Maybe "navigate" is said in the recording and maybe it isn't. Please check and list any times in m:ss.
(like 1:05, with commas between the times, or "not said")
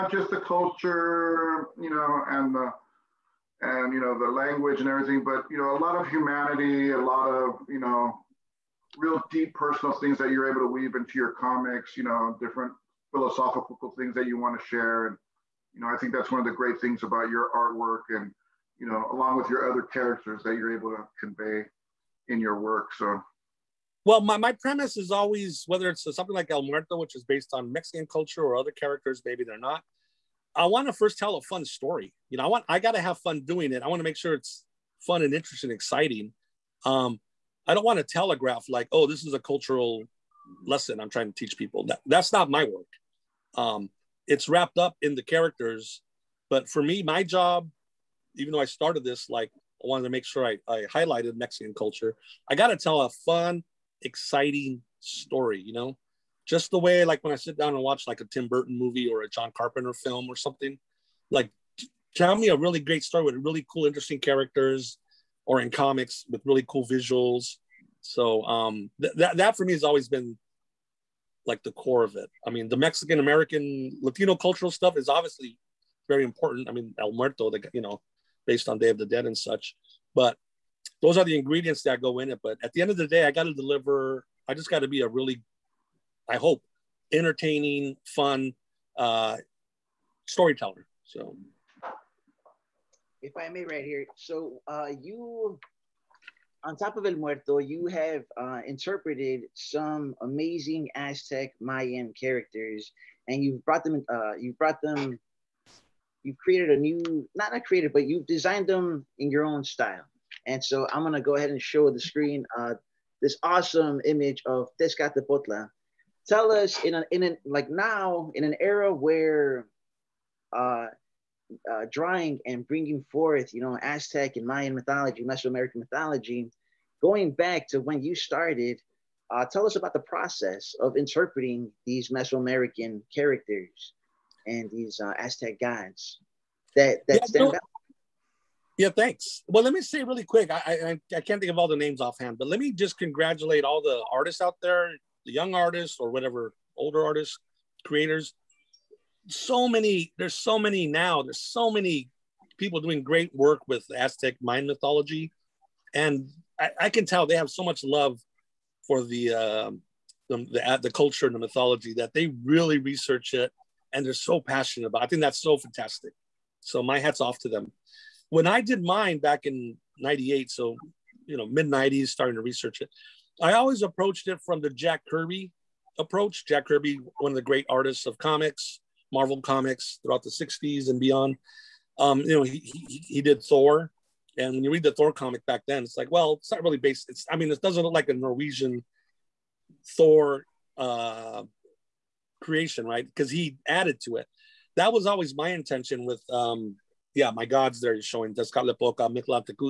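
not said.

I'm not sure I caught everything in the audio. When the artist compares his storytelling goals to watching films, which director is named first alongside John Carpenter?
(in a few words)
Tim Burton.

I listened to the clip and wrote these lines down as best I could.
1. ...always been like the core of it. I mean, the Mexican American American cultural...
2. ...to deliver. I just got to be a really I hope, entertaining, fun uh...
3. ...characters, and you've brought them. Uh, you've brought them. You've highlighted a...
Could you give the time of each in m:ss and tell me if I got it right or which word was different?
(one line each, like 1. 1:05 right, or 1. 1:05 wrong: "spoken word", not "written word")
1. 1:09 wrong: "Latino", not "American"
2. 1:23 right
3. 1:42 wrong: "created", not "highlighted".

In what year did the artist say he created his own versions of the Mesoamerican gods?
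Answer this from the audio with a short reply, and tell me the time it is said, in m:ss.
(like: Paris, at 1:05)
1998, at 2:49.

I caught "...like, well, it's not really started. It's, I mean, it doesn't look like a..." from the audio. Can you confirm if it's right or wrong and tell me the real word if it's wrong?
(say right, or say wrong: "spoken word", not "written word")
wrong: "based", not "started".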